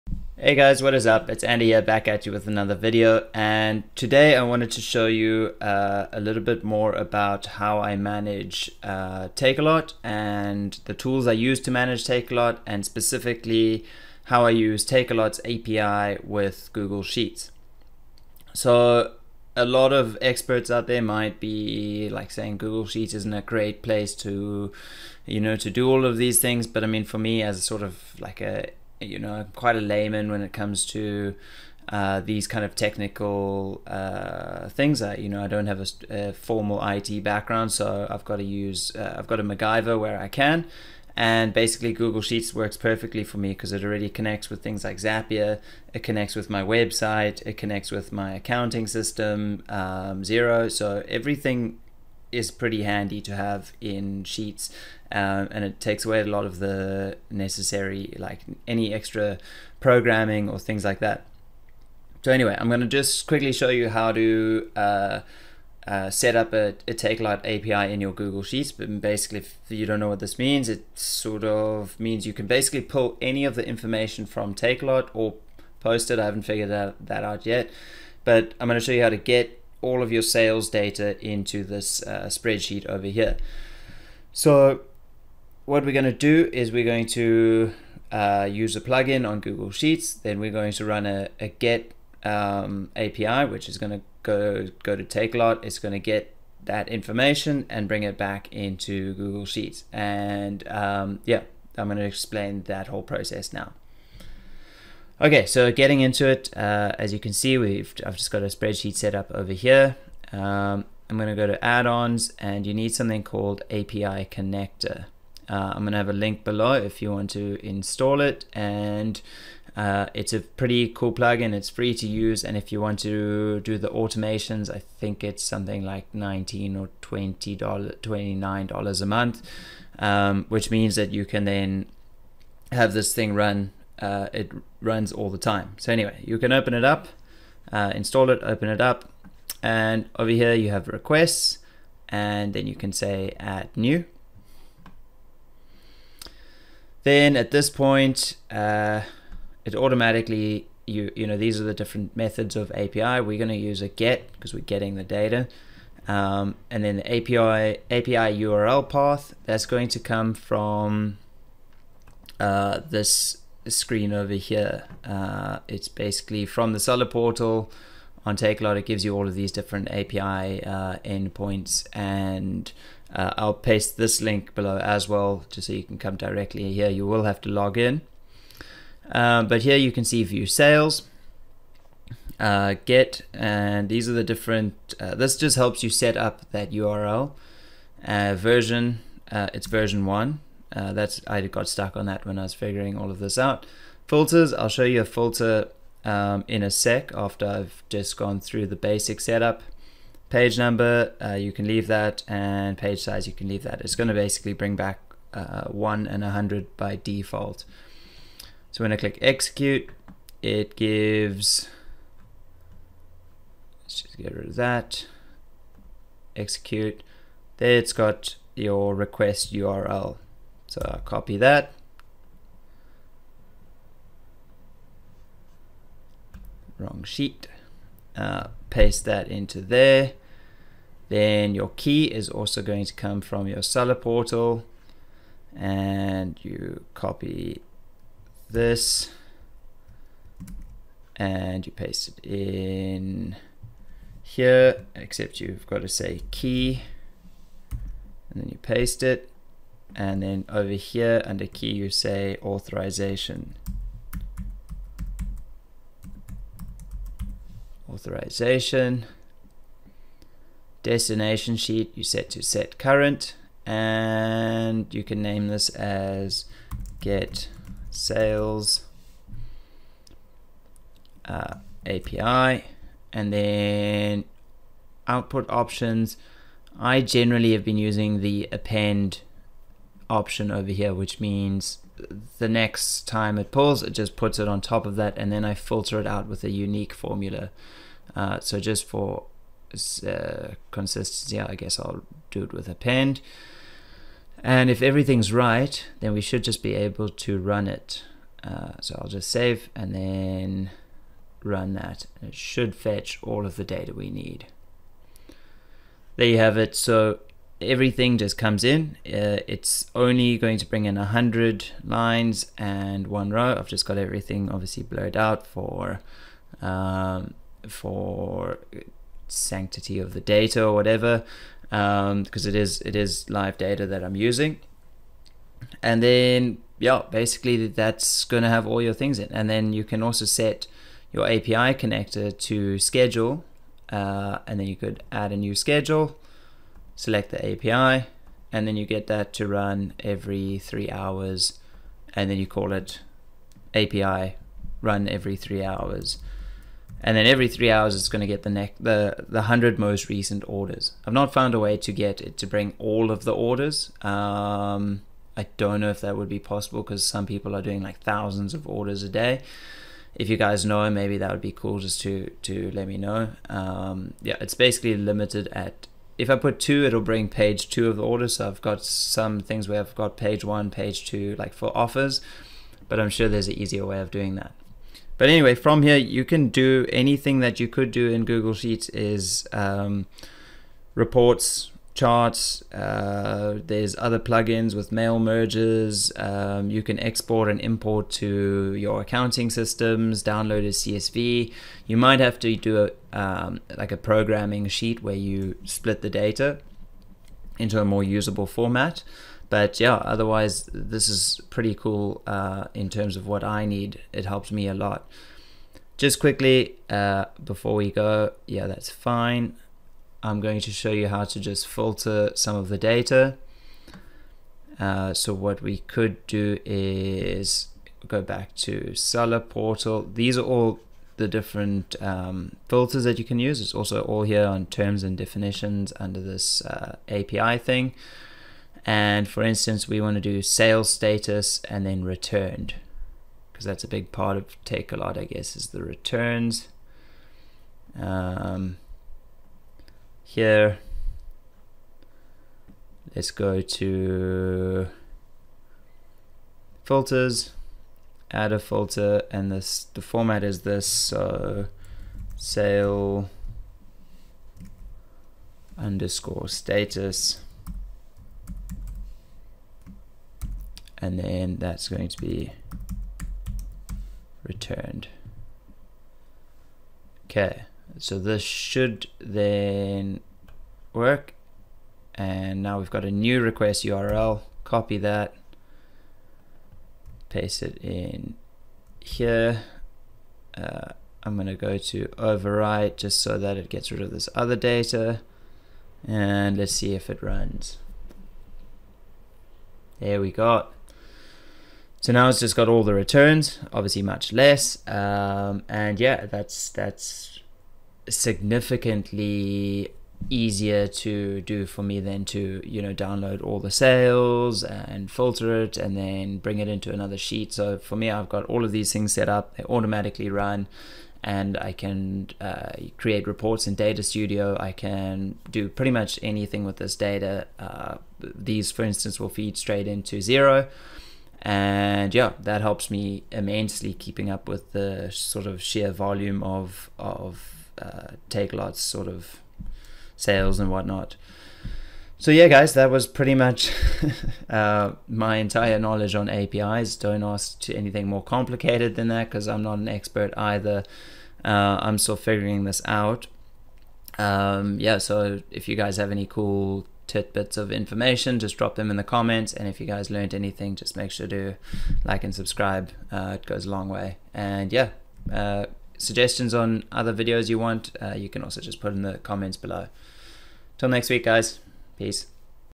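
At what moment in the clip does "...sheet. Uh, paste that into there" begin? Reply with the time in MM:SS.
03:47.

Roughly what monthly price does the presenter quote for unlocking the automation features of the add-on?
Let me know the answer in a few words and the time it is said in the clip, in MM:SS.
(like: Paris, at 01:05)
$29, at 02:07.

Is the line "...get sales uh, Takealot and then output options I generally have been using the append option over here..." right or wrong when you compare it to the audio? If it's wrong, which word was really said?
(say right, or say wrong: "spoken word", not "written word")
wrong: "API", not "Takealot".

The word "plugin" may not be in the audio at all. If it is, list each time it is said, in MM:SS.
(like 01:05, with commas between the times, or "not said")
01:28, 02:01, 06:24.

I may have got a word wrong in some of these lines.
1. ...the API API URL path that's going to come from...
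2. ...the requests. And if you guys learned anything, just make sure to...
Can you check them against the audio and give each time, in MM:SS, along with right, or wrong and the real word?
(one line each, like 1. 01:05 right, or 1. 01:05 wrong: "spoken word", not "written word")
1. 02:36 right
2. 09:08 wrong: "comments", not "requests".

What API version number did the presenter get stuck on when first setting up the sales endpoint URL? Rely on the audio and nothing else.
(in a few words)
1.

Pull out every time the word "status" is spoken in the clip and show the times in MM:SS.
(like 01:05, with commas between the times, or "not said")
07:10, 07:36.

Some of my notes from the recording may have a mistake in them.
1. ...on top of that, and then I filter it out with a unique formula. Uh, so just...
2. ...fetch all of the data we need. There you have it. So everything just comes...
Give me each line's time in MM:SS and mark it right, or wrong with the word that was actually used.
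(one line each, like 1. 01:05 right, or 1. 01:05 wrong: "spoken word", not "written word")
1. 04:44 right
2. 05:02 right.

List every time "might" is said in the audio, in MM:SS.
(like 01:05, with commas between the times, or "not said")
00:21, 06:31.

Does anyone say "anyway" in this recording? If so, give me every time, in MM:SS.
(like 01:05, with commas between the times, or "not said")
01:02, 02:15, 06:15.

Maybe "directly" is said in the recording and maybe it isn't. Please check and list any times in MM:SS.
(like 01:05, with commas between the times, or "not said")
02:56.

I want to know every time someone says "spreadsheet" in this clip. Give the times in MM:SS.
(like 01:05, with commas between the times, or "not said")
01:22, 01:48.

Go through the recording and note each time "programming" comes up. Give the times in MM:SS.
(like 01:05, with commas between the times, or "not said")
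00:59, 06:33.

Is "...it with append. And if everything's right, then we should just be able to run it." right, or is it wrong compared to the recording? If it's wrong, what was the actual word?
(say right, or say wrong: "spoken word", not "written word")
right.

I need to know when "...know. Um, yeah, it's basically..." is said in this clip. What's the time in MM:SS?
06:02.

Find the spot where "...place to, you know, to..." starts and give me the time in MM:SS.
00:23.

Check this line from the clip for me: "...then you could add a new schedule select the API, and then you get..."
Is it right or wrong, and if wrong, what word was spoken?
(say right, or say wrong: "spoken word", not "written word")
right.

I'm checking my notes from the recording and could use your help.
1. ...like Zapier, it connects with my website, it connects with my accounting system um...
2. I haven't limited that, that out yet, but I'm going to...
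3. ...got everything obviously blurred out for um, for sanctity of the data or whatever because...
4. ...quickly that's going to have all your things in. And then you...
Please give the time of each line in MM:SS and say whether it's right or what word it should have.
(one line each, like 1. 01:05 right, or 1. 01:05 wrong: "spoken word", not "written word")
1. 00:44 right
2. 01:16 wrong: "figured", not "limited"
3. 05:13 right
4. 05:27 wrong: "basically", not "quickly".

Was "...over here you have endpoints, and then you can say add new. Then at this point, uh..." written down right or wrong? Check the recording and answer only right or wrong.
wrong.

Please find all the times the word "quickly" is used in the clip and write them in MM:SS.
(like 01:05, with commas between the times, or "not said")
01:03, 06:46.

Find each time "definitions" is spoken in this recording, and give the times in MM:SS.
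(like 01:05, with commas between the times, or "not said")
07:05.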